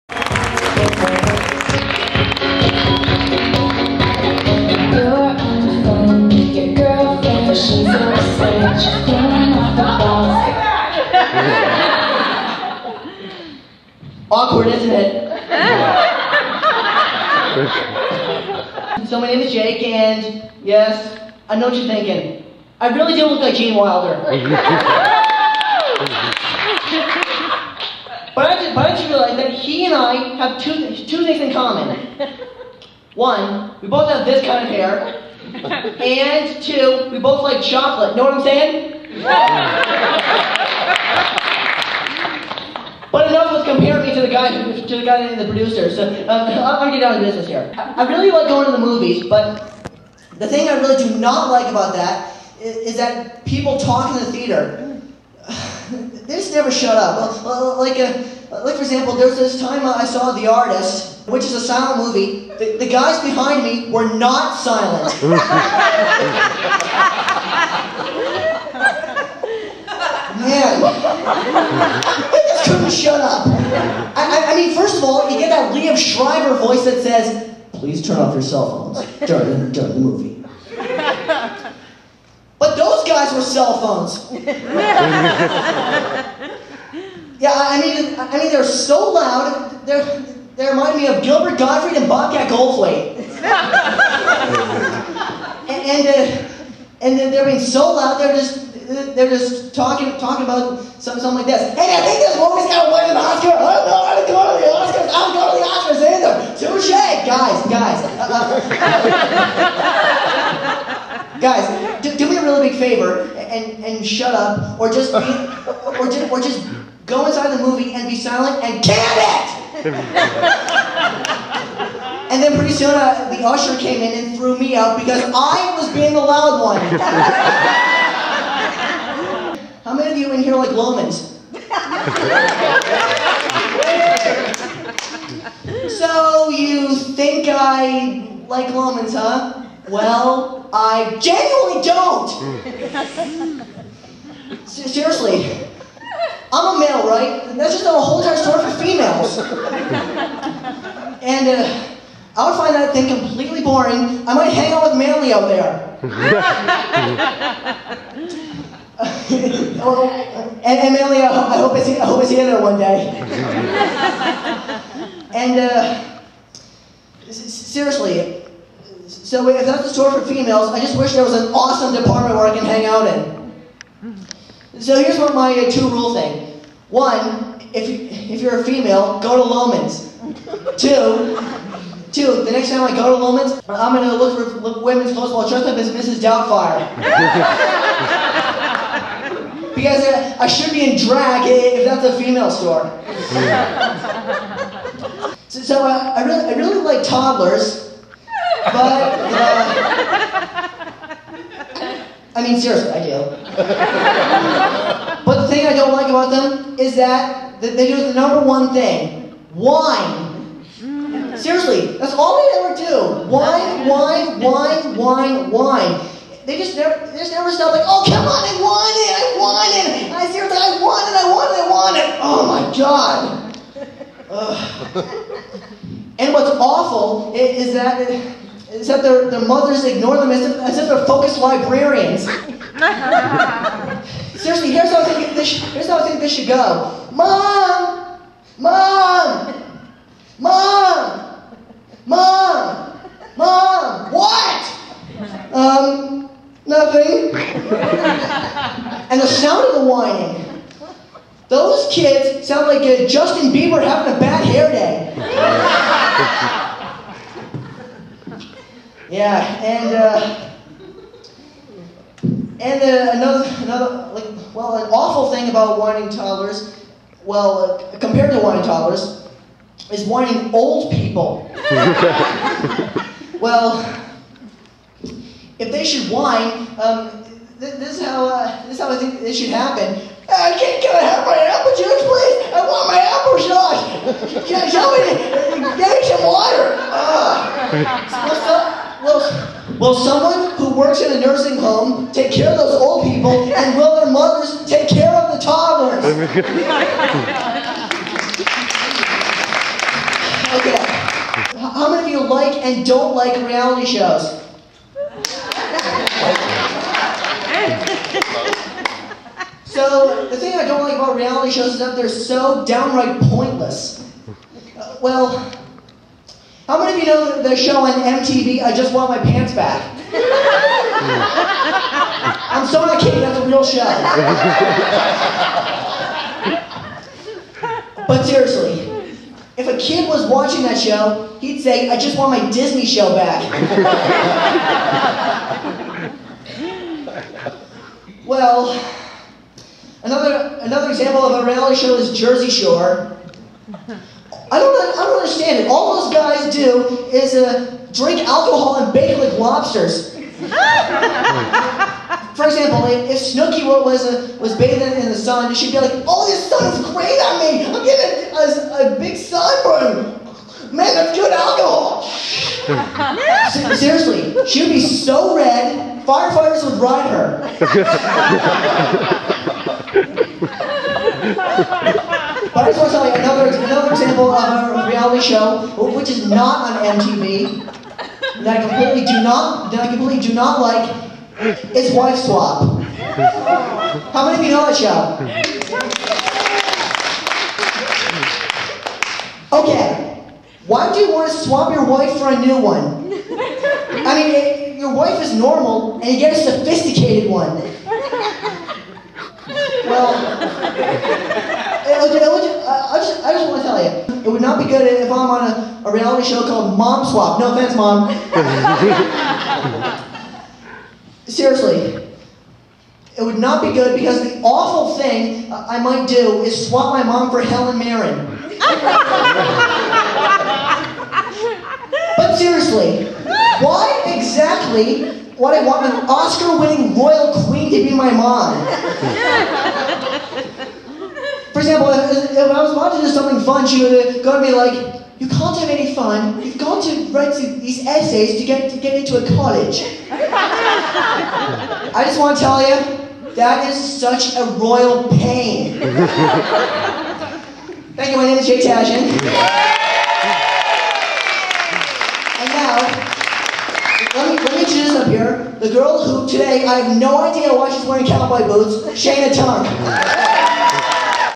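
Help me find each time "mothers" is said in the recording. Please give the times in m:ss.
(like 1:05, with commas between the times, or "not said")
3:49, 4:54.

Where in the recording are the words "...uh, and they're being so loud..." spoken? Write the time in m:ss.
1:36.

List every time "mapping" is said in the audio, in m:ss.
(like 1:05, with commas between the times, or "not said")
not said.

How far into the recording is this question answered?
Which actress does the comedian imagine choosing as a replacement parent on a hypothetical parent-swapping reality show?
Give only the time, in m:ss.
6:57.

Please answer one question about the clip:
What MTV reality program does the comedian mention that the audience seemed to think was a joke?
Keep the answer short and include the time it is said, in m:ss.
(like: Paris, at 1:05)
I Just Want My Pants Back, at 5:18.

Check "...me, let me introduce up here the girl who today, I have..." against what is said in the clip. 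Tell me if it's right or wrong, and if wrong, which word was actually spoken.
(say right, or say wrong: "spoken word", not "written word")
right.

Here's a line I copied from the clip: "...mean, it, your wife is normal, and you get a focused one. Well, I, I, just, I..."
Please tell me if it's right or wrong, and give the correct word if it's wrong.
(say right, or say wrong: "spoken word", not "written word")
wrong: "sophisticated", not "focused".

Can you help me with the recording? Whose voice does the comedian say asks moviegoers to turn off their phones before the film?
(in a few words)
Liev Schreiber.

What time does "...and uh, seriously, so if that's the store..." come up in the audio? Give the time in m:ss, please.
2:45.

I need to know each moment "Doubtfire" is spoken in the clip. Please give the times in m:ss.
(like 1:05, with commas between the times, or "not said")
3:06.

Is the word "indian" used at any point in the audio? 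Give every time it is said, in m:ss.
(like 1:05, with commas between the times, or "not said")
not said.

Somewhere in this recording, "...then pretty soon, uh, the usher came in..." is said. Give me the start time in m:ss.
2:02.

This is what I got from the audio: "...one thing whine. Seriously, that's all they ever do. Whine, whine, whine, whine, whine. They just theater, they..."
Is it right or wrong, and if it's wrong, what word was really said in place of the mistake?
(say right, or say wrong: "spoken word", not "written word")
wrong: "never", not "theater".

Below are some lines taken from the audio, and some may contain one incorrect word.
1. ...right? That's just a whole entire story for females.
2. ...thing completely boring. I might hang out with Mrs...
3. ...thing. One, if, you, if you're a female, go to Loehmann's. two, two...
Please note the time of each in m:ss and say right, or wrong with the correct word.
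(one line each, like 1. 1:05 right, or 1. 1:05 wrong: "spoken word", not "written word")
1. 2:27 right
2. 2:32 wrong: "Manly", not "Mrs"
3. 2:56 right.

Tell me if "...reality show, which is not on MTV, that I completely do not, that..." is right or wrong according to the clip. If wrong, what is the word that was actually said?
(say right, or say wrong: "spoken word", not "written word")
right.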